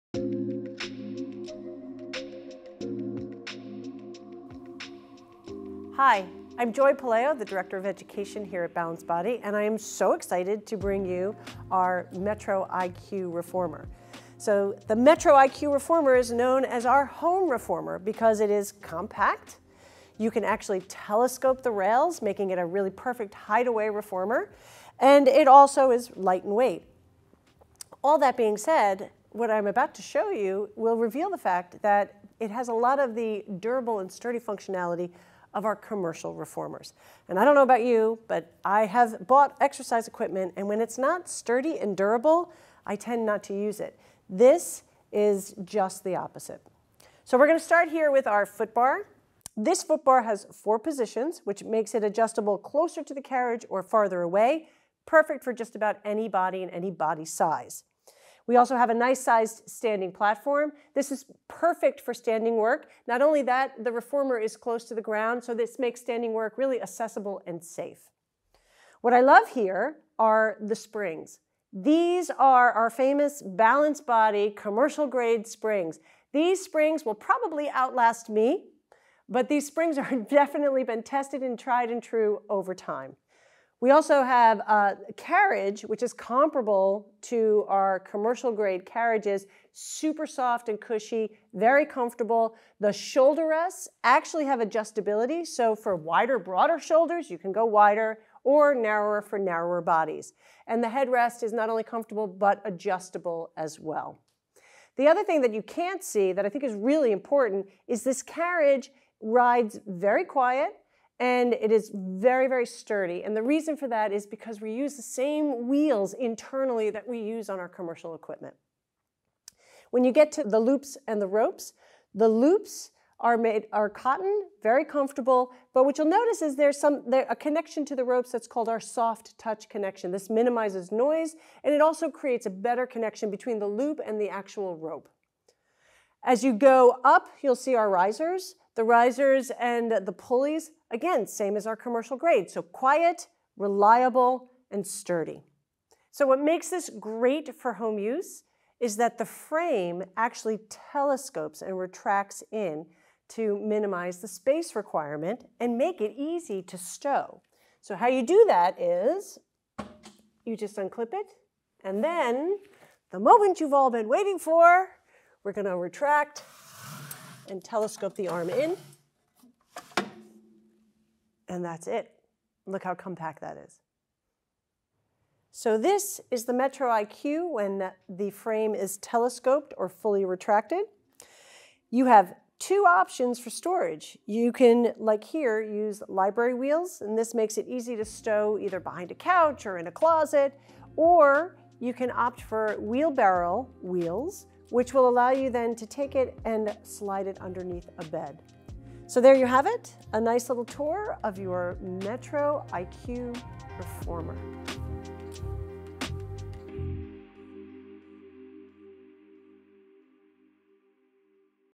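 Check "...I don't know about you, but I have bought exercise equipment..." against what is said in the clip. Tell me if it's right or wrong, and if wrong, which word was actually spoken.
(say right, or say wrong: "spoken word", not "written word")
right.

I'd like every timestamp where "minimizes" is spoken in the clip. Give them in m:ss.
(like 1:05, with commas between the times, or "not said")
2:10, 2:33.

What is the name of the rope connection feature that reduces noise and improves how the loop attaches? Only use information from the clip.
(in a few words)
soft touch connection.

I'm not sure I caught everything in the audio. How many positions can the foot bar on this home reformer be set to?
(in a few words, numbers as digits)
4.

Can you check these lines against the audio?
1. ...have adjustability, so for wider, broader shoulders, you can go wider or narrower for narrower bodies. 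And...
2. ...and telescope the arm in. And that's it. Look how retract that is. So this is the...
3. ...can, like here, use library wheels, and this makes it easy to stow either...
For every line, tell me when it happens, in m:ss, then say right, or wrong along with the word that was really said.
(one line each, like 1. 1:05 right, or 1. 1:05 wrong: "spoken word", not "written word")
1. 1:34 right
2. 2:47 wrong: "compact", not "retract"
3. 3:04 right.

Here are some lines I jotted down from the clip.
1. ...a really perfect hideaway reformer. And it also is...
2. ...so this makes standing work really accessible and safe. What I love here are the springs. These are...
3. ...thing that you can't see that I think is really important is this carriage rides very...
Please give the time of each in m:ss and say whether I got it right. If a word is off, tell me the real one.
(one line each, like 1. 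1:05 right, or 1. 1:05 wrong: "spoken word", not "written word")
1. 0:22 right
2. 1:05 right
3. 1:45 right.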